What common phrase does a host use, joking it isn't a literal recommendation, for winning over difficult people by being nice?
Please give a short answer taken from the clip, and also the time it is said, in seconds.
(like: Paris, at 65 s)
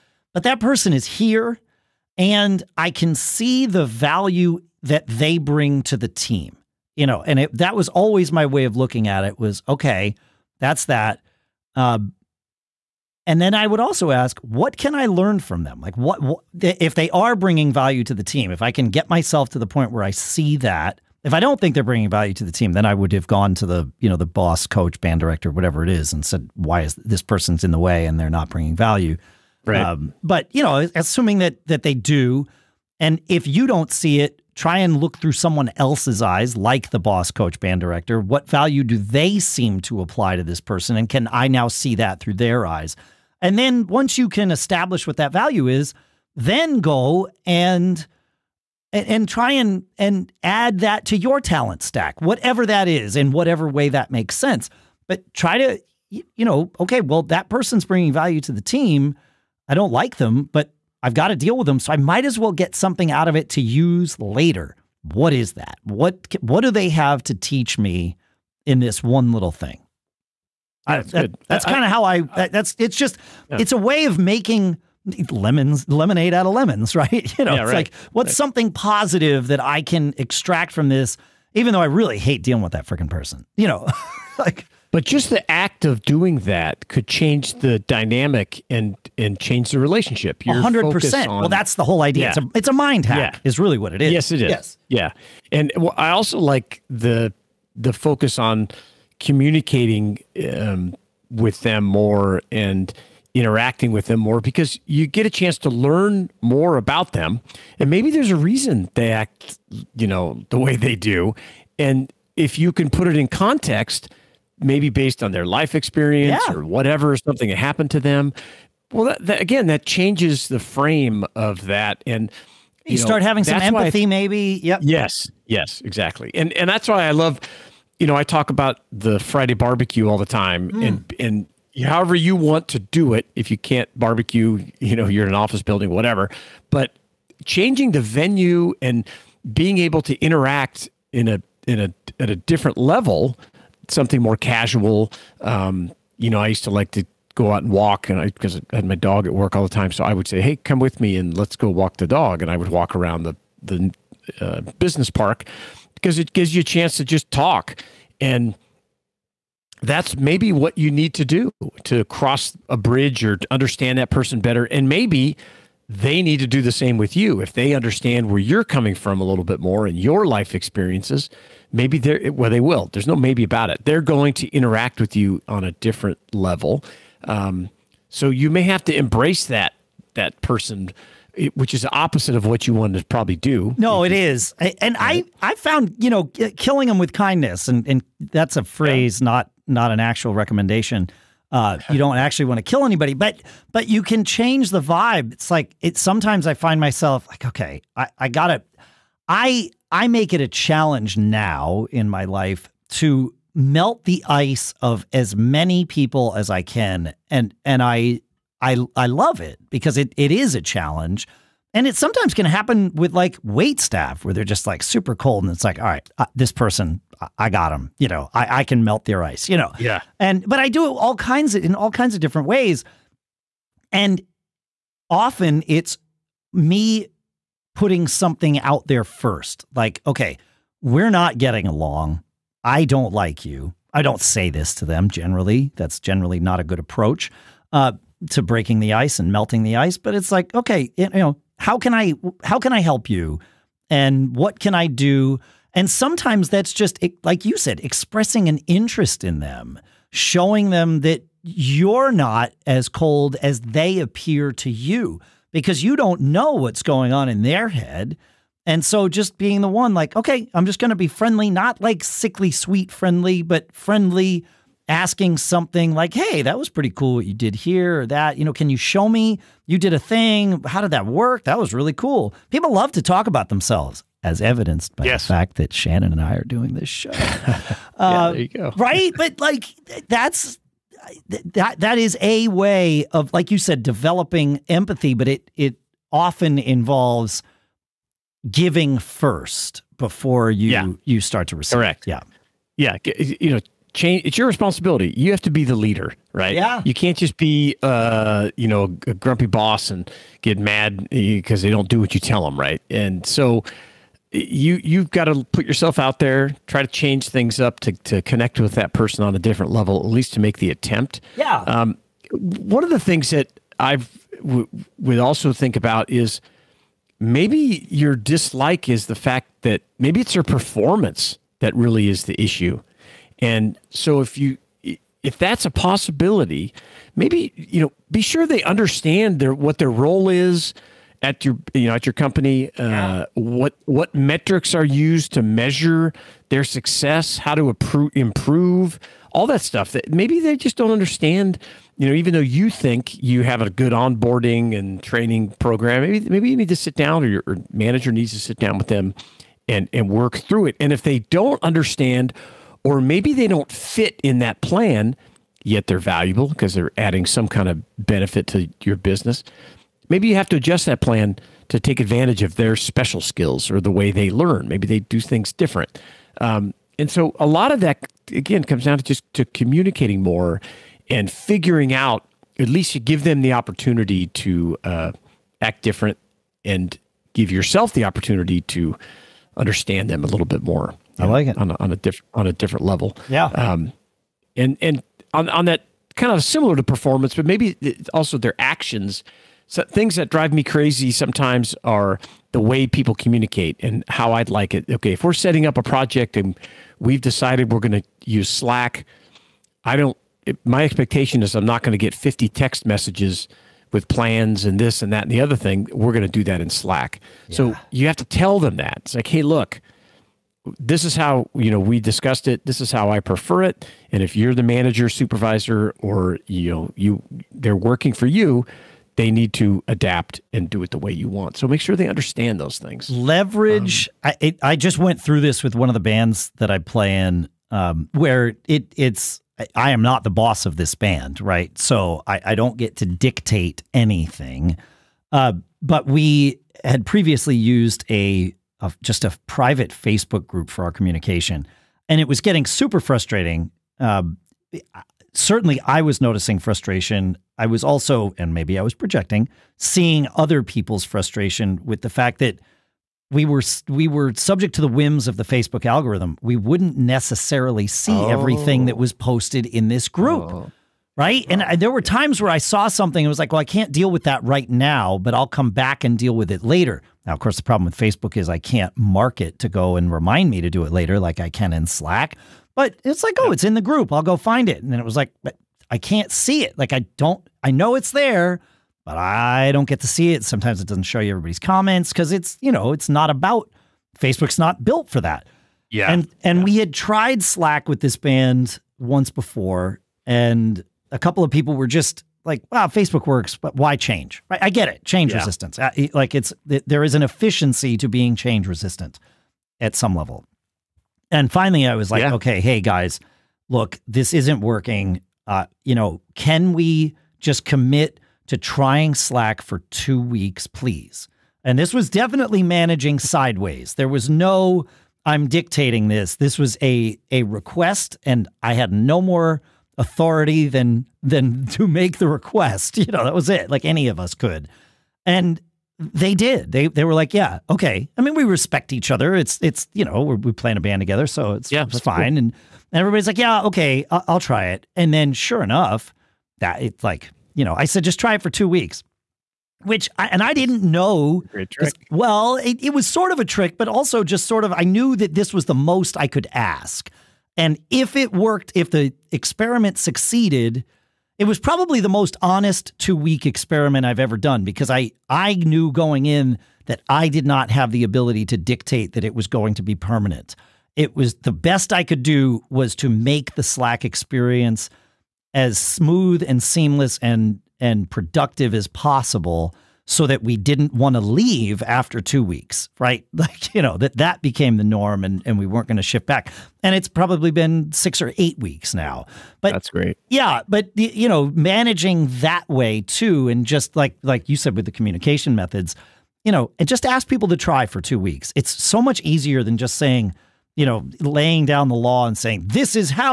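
killing them with kindness, at 186 s.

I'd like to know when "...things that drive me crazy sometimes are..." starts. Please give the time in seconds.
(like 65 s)
389 s.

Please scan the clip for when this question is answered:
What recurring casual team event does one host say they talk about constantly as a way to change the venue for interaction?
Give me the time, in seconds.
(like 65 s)
129 s.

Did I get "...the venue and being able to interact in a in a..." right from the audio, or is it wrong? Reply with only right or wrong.
right.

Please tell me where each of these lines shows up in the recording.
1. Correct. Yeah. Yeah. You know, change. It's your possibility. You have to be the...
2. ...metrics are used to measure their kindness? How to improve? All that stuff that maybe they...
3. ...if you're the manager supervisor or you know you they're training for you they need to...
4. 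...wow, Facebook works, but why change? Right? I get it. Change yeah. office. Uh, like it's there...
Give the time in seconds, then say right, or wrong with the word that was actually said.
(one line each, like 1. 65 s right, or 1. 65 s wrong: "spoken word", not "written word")
1. 291 s wrong: "responsibility", not "possibility"
2. 334 s wrong: "success", not "kindness"
3. 414 s wrong: "working", not "training"
4. 492 s wrong: "resistance", not "office".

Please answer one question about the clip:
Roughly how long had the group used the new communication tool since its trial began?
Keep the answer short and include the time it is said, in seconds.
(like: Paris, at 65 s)
6 or 8 weeks, at 577 s.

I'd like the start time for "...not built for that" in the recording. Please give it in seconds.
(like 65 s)
484 s.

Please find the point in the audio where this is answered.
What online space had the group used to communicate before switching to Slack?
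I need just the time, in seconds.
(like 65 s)
439 s.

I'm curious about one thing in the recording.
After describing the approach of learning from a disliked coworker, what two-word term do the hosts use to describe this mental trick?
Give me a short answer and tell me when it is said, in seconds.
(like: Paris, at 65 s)
mind hack, at 92 s.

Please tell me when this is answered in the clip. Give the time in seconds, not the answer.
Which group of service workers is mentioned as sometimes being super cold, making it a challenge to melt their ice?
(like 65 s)
213 s.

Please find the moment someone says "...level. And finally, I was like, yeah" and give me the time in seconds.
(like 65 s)
500 s.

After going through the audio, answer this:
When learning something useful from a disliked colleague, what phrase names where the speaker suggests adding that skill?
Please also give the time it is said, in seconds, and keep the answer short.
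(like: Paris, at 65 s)
talent stack, at 51 s.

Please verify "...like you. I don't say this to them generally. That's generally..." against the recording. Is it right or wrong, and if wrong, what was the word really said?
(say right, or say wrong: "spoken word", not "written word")
right.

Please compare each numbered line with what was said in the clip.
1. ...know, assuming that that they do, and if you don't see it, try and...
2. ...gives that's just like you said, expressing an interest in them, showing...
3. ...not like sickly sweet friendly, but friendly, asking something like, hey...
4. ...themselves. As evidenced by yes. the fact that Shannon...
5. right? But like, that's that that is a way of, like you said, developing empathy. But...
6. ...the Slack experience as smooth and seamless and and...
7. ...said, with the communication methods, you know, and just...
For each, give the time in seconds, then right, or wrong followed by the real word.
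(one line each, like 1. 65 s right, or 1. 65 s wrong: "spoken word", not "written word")
1. 30 s right
2. 245 s wrong: "sometimes", not "gives"
3. 261 s right
4. 273 s right
5. 278 s right
6. 563 s right
7. 584 s right.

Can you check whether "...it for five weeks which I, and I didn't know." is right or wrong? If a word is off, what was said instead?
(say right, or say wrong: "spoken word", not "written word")
wrong: "two", not "five".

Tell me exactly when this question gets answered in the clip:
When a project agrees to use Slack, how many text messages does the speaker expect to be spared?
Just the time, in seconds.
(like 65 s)
402 s.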